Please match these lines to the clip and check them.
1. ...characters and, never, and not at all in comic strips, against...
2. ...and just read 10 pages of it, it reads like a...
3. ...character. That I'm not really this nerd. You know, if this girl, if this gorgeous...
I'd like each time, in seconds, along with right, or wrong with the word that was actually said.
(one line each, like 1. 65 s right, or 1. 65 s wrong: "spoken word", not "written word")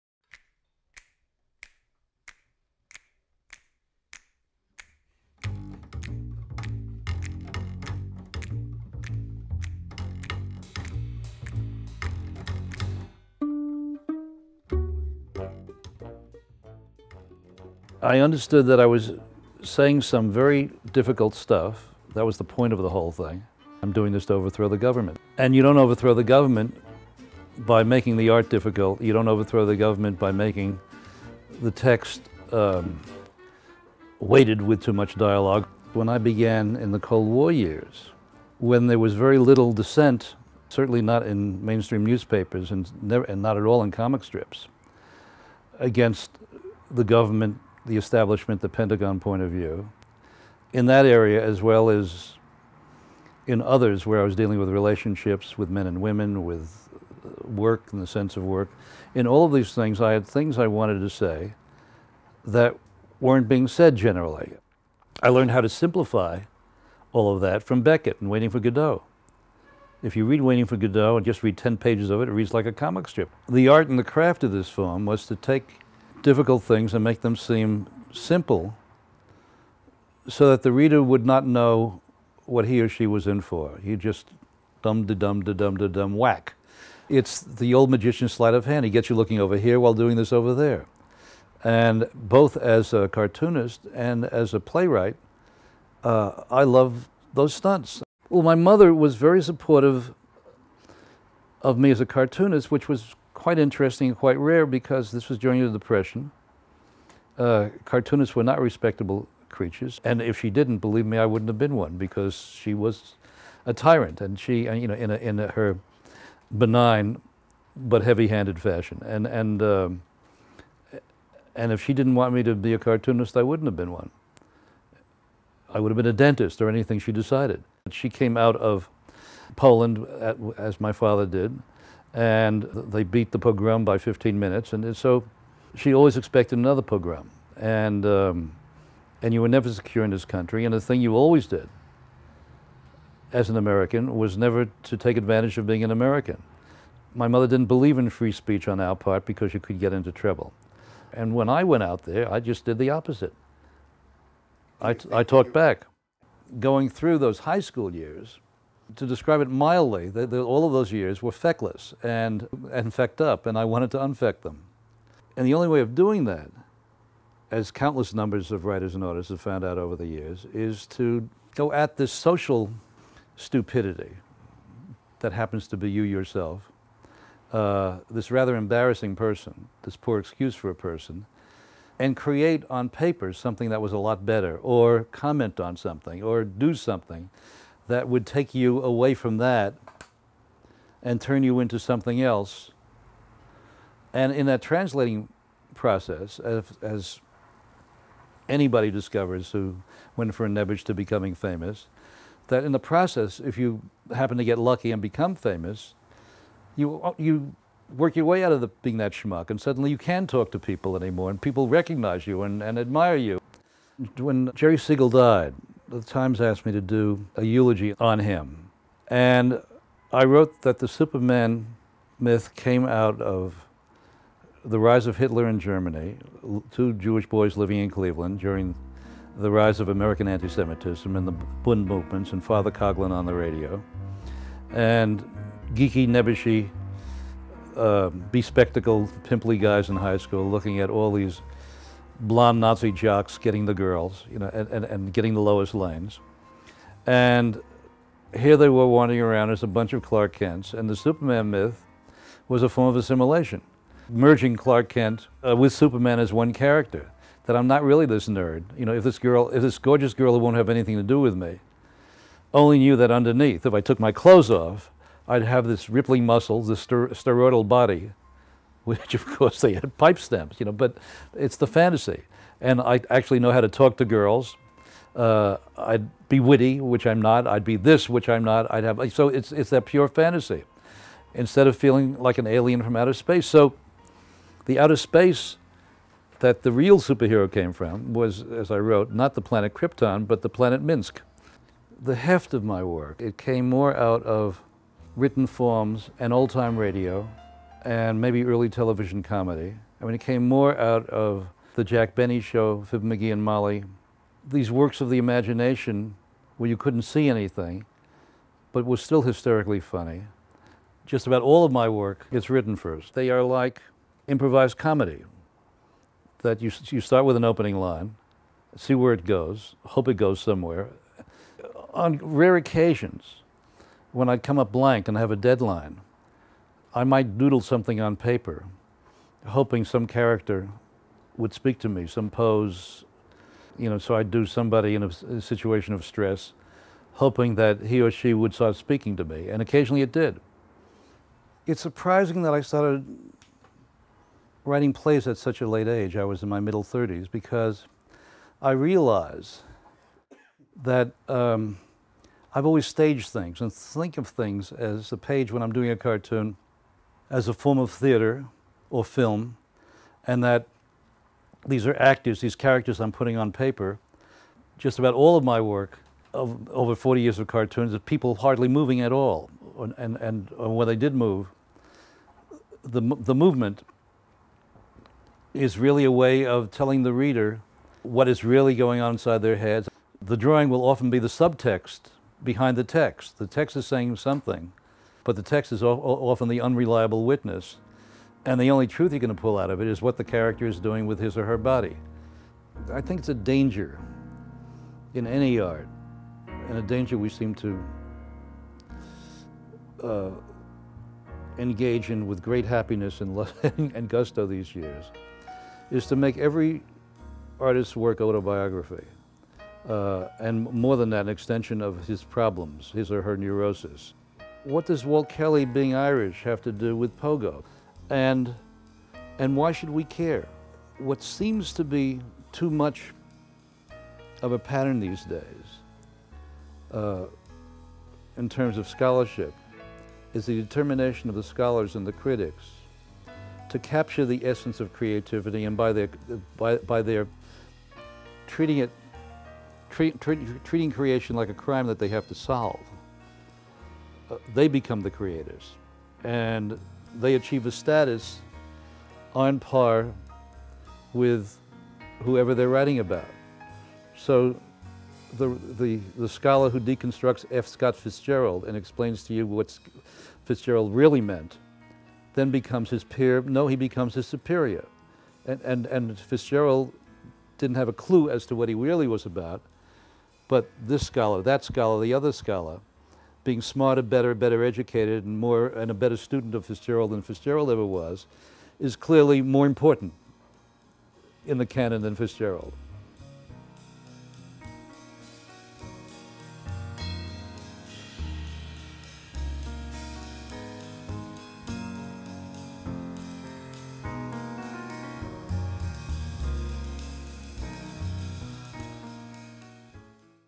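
1. 42 s wrong: "newspapers", not "characters"
2. 71 s right
3. 256 s right.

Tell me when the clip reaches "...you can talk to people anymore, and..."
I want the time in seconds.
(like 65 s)
209 s.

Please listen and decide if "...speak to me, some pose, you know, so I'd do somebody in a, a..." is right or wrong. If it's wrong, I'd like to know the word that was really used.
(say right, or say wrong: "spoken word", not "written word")
right.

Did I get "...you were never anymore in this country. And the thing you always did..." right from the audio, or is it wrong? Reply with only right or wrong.
wrong.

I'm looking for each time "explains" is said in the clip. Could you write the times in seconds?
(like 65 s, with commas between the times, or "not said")
458 s.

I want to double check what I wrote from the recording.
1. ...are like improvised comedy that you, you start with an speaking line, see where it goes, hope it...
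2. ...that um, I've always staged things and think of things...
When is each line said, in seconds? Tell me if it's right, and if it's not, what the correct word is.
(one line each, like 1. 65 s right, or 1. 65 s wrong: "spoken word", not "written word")
1. 313 s wrong: "opening", not "speaking"
2. 350 s right.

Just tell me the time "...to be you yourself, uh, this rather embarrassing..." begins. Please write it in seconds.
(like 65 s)
175 s.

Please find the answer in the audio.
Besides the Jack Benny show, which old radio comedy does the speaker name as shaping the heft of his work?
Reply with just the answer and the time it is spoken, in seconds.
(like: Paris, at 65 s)
Fibber McGee and Molly, at 302 s.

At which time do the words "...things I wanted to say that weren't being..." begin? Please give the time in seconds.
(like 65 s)
60 s.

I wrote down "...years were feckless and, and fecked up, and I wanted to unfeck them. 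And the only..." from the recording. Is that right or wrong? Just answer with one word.
right.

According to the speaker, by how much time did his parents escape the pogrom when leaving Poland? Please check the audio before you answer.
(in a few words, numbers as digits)
15 minutes.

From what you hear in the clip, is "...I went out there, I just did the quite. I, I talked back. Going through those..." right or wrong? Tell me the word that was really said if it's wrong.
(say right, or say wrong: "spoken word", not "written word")
wrong: "opposite", not "quite".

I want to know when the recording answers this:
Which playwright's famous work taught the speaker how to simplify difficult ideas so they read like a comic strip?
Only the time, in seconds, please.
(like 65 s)
67 s.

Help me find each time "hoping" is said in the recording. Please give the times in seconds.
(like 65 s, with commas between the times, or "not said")
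329 s, 337 s.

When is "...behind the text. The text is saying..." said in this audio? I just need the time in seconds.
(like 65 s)
382 s.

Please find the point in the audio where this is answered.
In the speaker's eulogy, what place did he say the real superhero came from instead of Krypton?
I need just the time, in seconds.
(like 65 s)
290 s.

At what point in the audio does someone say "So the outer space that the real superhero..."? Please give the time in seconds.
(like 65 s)
283 s.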